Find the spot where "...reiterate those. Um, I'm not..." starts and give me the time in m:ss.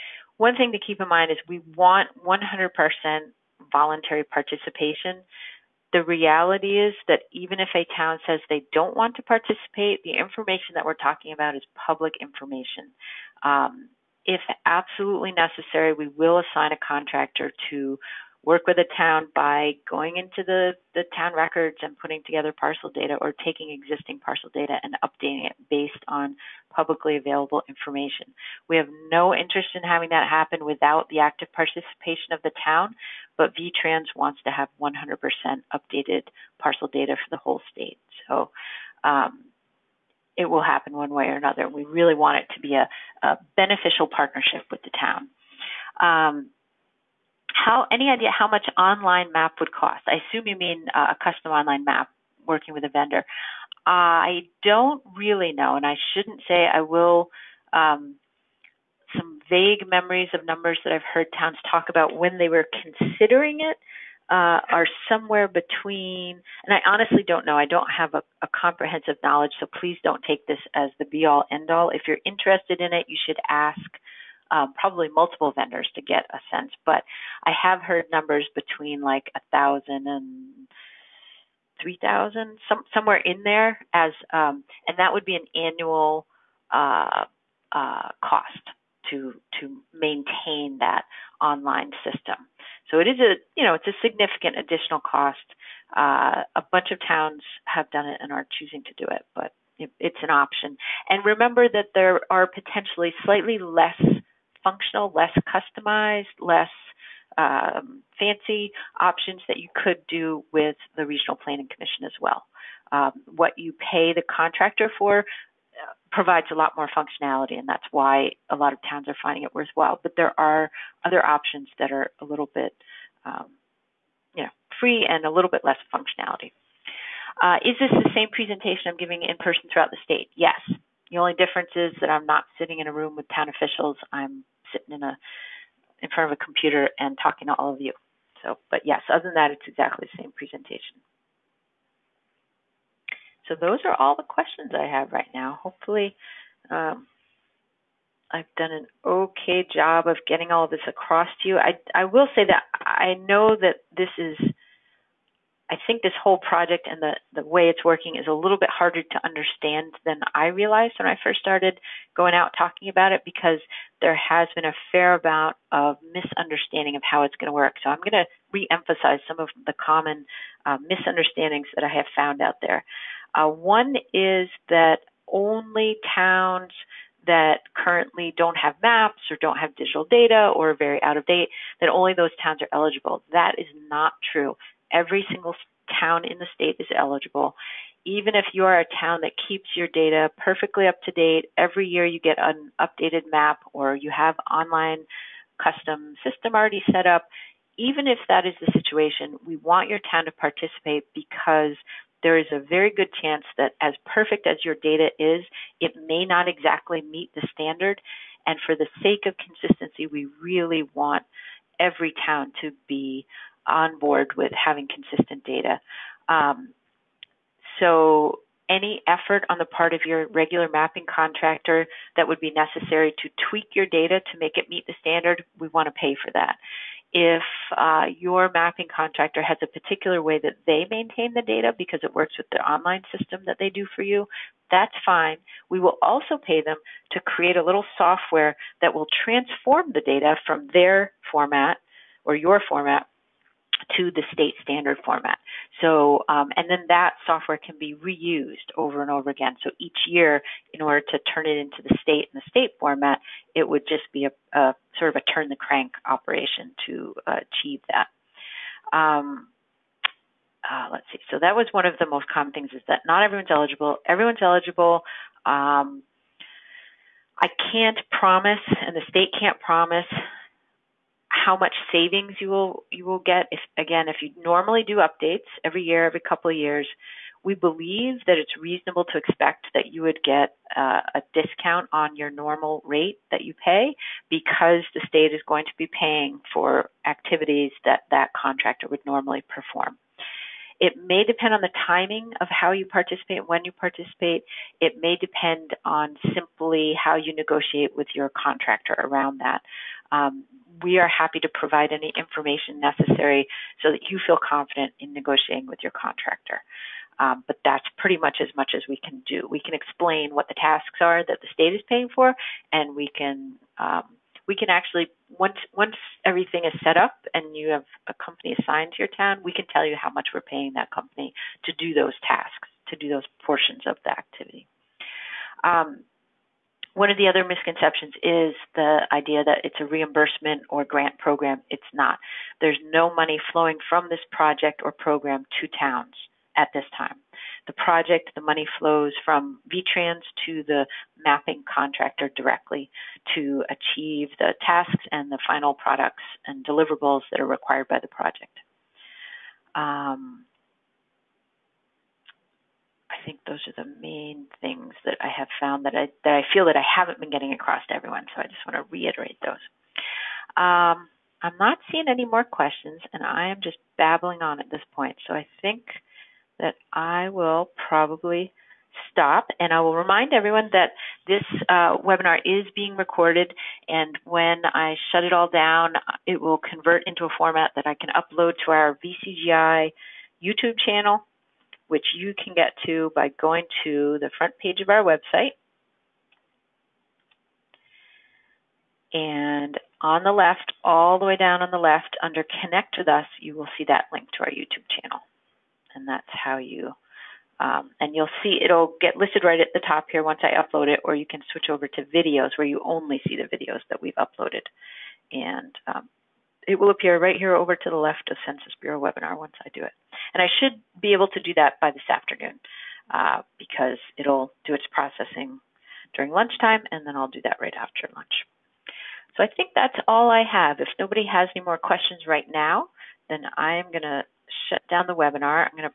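5:58.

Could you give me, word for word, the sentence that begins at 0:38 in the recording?
So um, it will happen one way or another.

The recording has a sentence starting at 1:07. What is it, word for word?
I don't have a, a comprehensive knowledge, so please don't take this as the be all end all.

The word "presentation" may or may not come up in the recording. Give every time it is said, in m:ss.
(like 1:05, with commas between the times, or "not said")
2:08, 2:20.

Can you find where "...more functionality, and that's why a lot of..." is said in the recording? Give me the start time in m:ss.
1:56.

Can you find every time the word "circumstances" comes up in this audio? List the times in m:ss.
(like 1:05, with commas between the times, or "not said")
not said.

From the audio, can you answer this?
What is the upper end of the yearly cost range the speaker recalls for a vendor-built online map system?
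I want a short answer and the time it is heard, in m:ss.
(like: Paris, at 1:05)
3,000, at 1:21.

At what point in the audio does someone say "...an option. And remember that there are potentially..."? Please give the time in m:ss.
1:40.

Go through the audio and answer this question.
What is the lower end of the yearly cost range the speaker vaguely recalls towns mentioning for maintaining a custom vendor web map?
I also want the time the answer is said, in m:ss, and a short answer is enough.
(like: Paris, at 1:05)
1,000, at 1:19.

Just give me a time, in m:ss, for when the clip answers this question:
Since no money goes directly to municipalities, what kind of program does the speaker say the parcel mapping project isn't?
5:29.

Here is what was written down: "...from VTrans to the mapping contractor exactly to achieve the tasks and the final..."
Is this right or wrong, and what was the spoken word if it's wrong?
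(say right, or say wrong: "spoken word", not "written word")
wrong: "directly", not "exactly".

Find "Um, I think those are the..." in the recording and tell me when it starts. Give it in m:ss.
5:49.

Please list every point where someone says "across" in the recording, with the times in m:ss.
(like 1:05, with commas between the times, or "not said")
2:30, 5:57.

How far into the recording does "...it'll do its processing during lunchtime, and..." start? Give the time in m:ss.
6:54.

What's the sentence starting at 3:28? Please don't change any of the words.
And for the sake of consistency, we really want every town to be on board with having consistent data.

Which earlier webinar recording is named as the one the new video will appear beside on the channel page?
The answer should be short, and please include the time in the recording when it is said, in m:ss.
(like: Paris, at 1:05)
Census Bureau webinar, at 6:48.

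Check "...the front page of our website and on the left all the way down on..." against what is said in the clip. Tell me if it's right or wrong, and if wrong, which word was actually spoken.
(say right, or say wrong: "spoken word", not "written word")
right.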